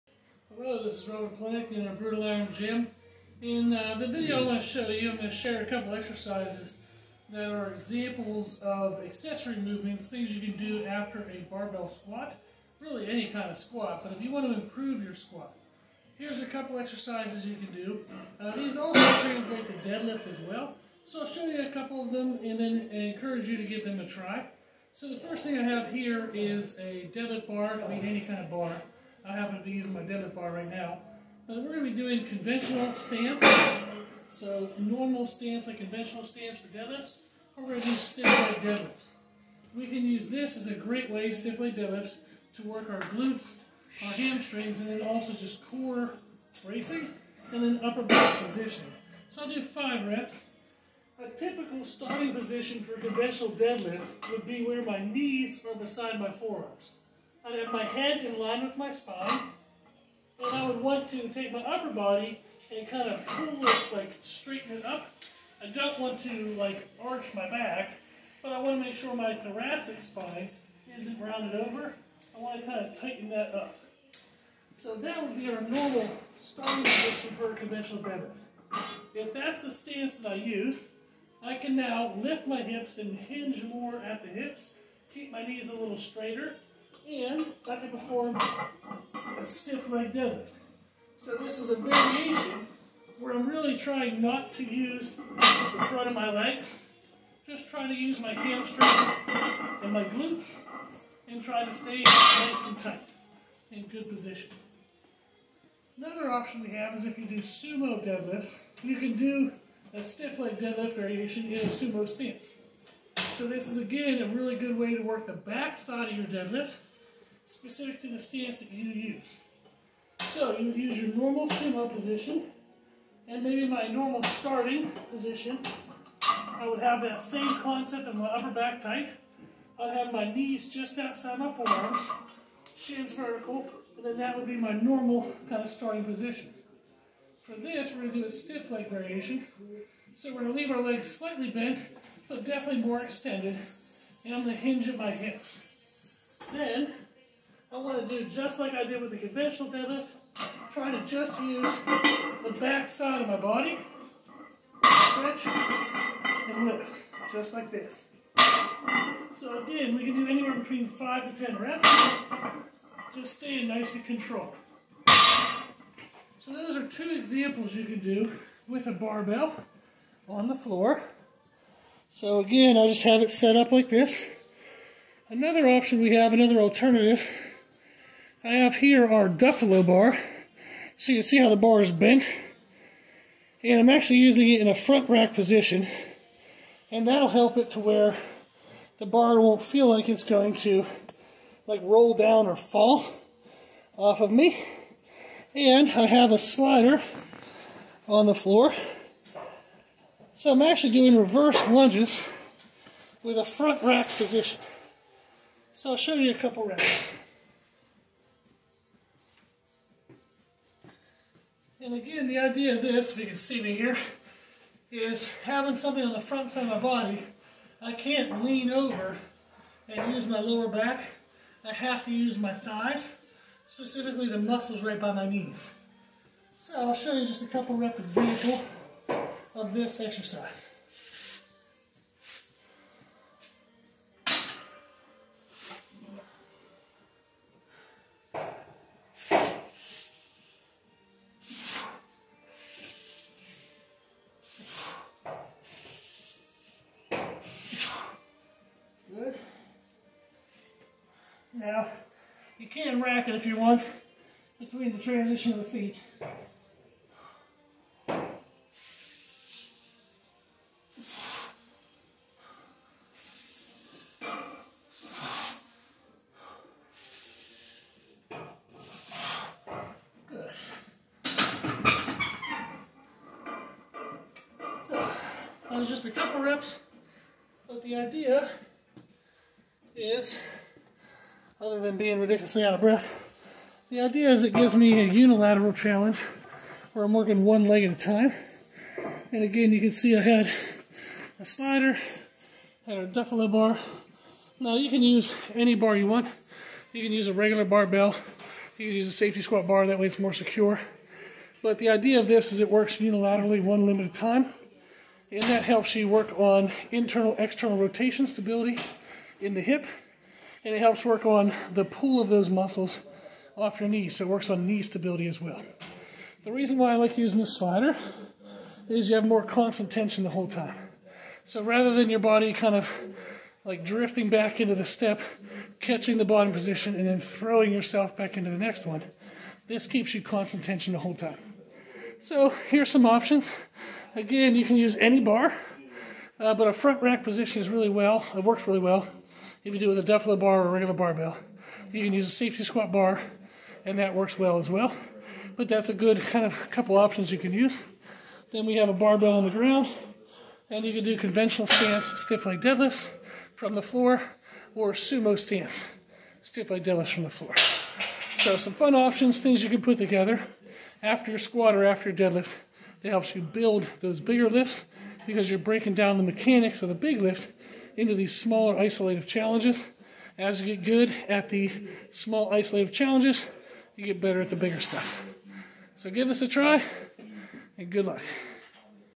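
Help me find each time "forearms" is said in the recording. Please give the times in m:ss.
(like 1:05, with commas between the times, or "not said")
0:56, 2:11.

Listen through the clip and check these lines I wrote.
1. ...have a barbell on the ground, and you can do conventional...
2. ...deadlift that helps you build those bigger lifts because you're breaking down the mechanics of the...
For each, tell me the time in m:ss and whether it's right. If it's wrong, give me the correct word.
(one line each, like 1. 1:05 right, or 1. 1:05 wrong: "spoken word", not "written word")
1. 5:48 right
2. 6:02 right.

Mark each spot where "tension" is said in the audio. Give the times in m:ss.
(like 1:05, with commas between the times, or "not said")
5:19, 5:30.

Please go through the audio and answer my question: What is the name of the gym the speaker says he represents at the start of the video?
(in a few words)
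Brutal Iron Gym.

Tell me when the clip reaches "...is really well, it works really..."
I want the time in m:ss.
5:37.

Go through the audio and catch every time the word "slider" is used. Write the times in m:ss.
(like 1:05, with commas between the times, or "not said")
3:16, 4:51, 5:17.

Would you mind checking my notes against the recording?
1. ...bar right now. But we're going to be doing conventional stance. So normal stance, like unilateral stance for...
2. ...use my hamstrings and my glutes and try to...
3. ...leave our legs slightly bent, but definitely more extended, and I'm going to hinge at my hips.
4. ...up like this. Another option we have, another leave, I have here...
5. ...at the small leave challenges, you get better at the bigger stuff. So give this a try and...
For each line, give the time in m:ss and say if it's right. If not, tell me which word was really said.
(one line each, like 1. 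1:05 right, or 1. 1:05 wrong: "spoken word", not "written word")
1. 0:30 wrong: "conventional", not "unilateral"
2. 1:37 right
3. 2:20 right
4. 2:53 wrong: "alternative", not "leave"
5. 6:11 wrong: "isolative", not "leave".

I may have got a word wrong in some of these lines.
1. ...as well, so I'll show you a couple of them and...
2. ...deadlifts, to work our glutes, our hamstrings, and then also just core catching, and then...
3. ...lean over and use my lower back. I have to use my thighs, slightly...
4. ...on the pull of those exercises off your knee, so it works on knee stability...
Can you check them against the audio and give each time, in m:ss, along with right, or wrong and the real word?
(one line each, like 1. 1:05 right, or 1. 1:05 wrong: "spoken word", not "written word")
1. 0:20 right
2. 0:41 wrong: "bracing", not "catching"
3. 3:38 wrong: "specifically", not "slightly"
4. 5:11 wrong: "muscles", not "exercises".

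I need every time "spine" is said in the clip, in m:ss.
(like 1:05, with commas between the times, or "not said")
0:58, 1:10.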